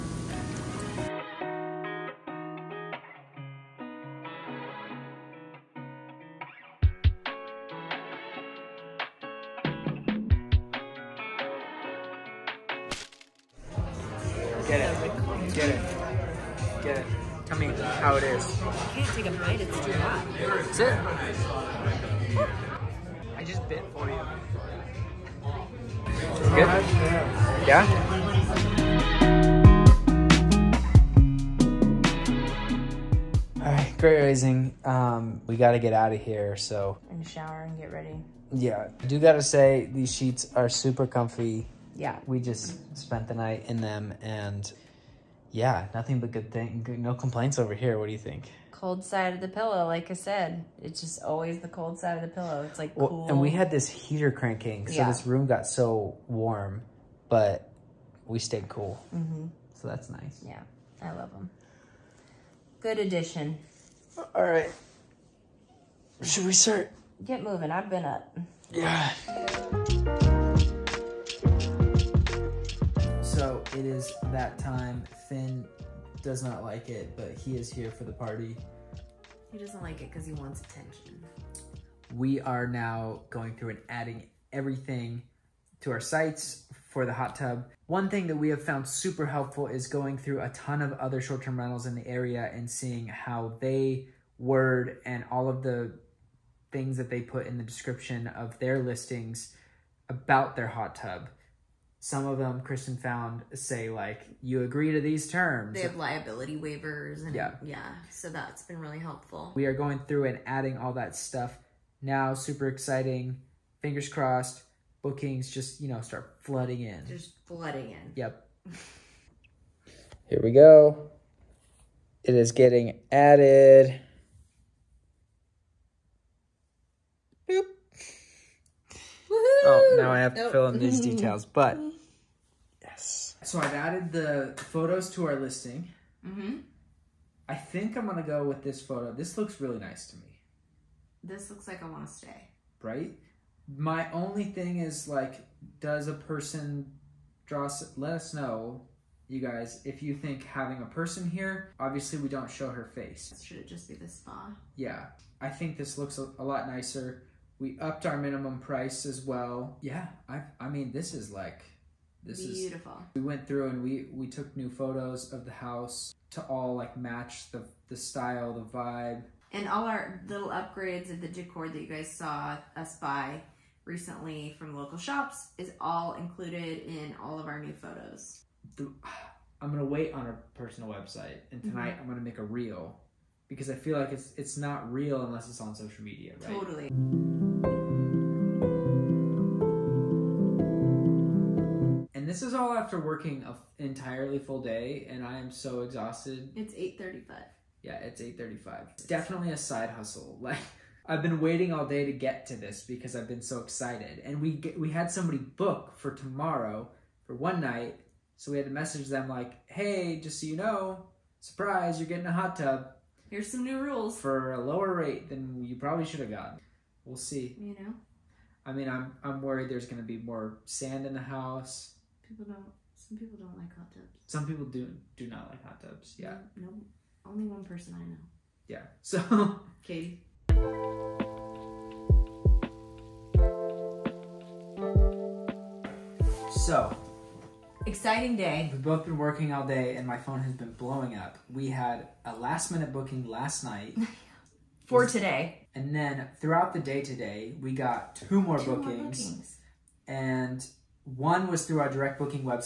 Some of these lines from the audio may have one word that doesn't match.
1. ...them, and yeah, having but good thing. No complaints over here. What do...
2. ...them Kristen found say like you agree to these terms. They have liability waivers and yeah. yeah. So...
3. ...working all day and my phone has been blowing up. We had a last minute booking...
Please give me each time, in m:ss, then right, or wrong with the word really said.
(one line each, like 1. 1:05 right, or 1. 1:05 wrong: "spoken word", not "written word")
1. 0:43 wrong: "nothing", not "having"
2. 1:42 right
3. 3:59 right.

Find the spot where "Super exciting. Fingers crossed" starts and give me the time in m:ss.
1:52.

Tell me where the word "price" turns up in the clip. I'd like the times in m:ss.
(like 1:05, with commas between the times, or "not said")
2:38.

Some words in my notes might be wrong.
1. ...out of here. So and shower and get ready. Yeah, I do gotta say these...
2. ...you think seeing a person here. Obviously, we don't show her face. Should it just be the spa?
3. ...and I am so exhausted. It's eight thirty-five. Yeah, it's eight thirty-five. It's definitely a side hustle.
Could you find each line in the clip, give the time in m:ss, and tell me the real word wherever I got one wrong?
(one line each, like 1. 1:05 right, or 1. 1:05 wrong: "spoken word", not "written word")
1. 0:35 right
2. 2:30 wrong: "having", not "seeing"
3. 3:15 right.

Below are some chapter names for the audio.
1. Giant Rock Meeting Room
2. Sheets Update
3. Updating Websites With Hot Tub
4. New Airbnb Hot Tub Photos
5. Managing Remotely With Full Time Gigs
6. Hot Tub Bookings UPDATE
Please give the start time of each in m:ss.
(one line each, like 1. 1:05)
1. 0:09
2. 0:32
3. 1:12
4. 2:12
5. 3:14
6. 3:55.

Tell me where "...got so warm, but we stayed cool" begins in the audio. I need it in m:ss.
0:55.